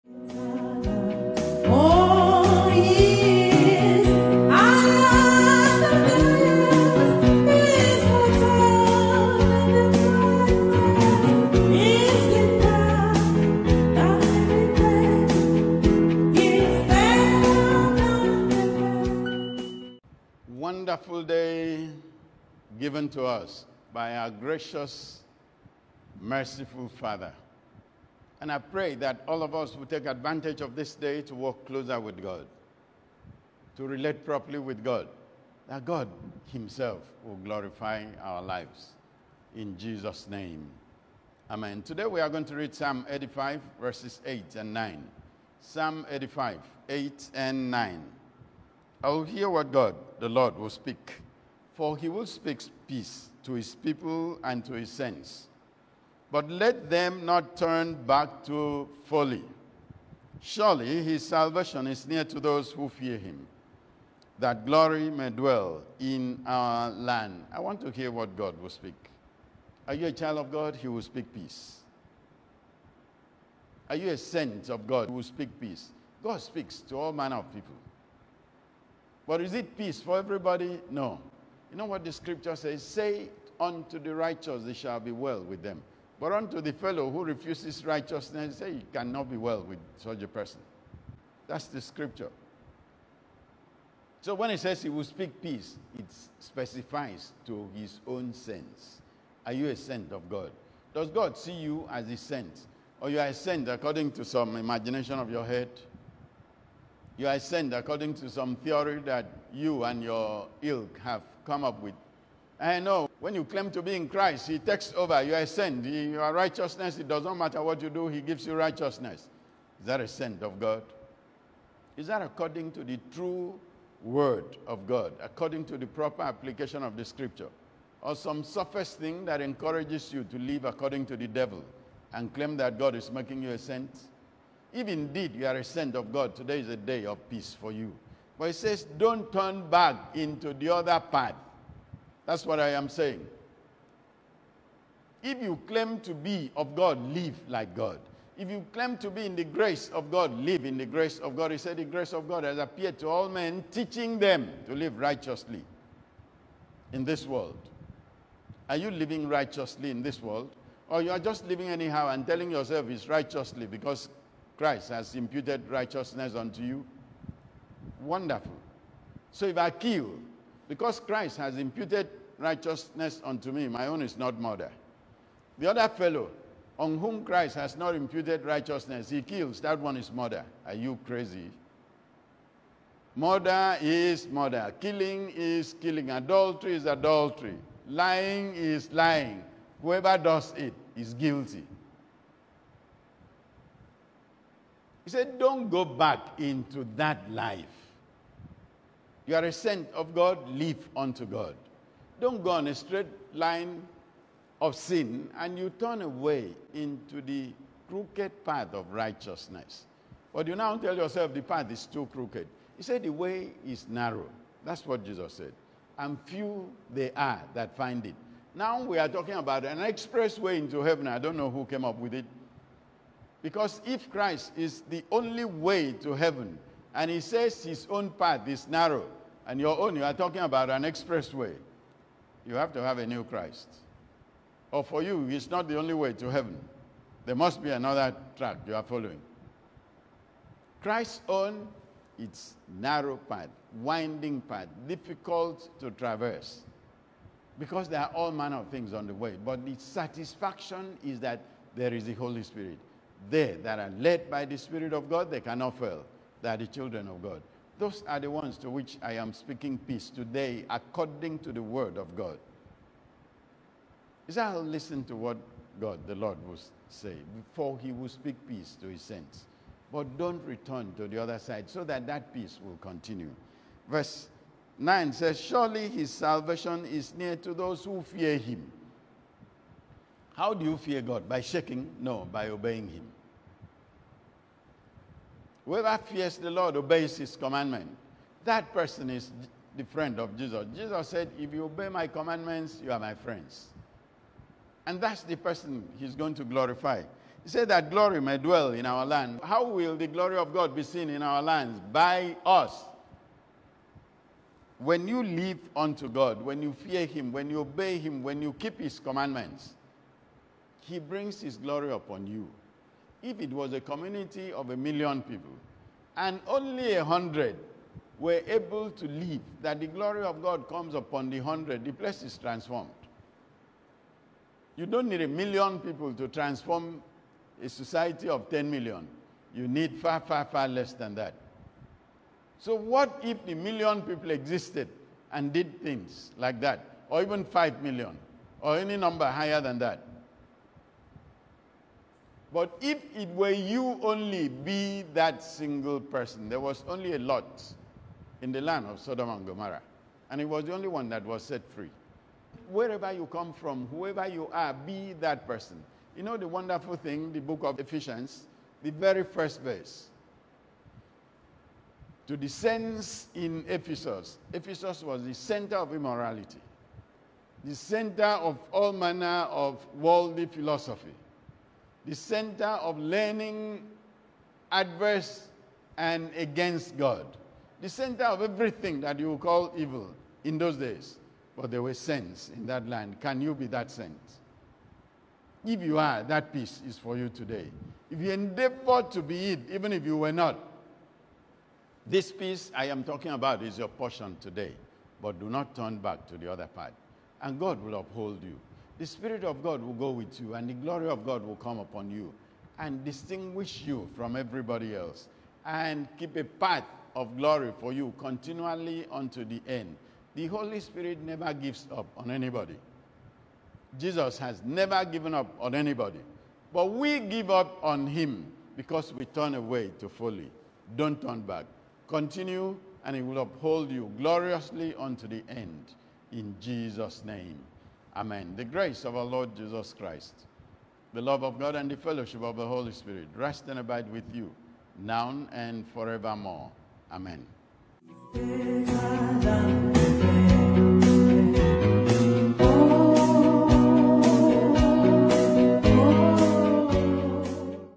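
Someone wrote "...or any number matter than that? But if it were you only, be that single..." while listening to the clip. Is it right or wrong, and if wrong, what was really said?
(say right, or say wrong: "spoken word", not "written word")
wrong: "higher", not "matter".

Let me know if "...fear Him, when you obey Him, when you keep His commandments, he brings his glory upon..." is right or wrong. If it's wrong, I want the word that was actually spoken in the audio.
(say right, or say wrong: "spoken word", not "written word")
right.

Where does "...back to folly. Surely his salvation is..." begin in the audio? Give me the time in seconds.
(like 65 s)
58 s.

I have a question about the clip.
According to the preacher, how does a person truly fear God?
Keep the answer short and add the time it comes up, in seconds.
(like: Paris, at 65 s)
By obeying Him, at 282 s.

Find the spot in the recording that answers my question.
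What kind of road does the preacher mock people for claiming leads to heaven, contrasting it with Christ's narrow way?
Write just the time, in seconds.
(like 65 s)
219 s.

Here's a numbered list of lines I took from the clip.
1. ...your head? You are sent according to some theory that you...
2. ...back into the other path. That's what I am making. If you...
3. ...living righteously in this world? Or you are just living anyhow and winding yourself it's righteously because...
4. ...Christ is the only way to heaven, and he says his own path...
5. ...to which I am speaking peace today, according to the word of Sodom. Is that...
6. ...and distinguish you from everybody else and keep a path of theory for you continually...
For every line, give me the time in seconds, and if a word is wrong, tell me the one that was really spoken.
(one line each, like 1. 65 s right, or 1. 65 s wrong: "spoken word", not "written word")
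1. 105 s right
2. 139 s wrong: "saying", not "making"
3. 158 s wrong: "telling", not "winding"
4. 224 s right
5. 258 s wrong: "God", not "Sodom"
6. 402 s wrong: "glory", not "theory".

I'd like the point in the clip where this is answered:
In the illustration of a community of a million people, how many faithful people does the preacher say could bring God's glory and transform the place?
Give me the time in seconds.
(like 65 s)
316 s.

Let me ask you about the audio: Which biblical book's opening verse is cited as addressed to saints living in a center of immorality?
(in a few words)
Ephesians.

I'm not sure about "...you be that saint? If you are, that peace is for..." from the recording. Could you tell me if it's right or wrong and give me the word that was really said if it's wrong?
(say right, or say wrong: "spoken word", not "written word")
right.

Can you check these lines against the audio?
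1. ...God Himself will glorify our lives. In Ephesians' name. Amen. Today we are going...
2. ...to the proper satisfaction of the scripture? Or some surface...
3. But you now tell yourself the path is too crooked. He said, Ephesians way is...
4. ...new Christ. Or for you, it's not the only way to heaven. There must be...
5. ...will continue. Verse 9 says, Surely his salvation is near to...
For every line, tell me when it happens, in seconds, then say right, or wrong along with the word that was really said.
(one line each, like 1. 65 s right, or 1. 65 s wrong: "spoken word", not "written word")
1. 35 s wrong: "Jesus", not "Ephesians"
2. 125 s wrong: "application", not "satisfaction"
3. 210 s wrong: "The", not "Ephesians"
4. 233 s right
5. 272 s right.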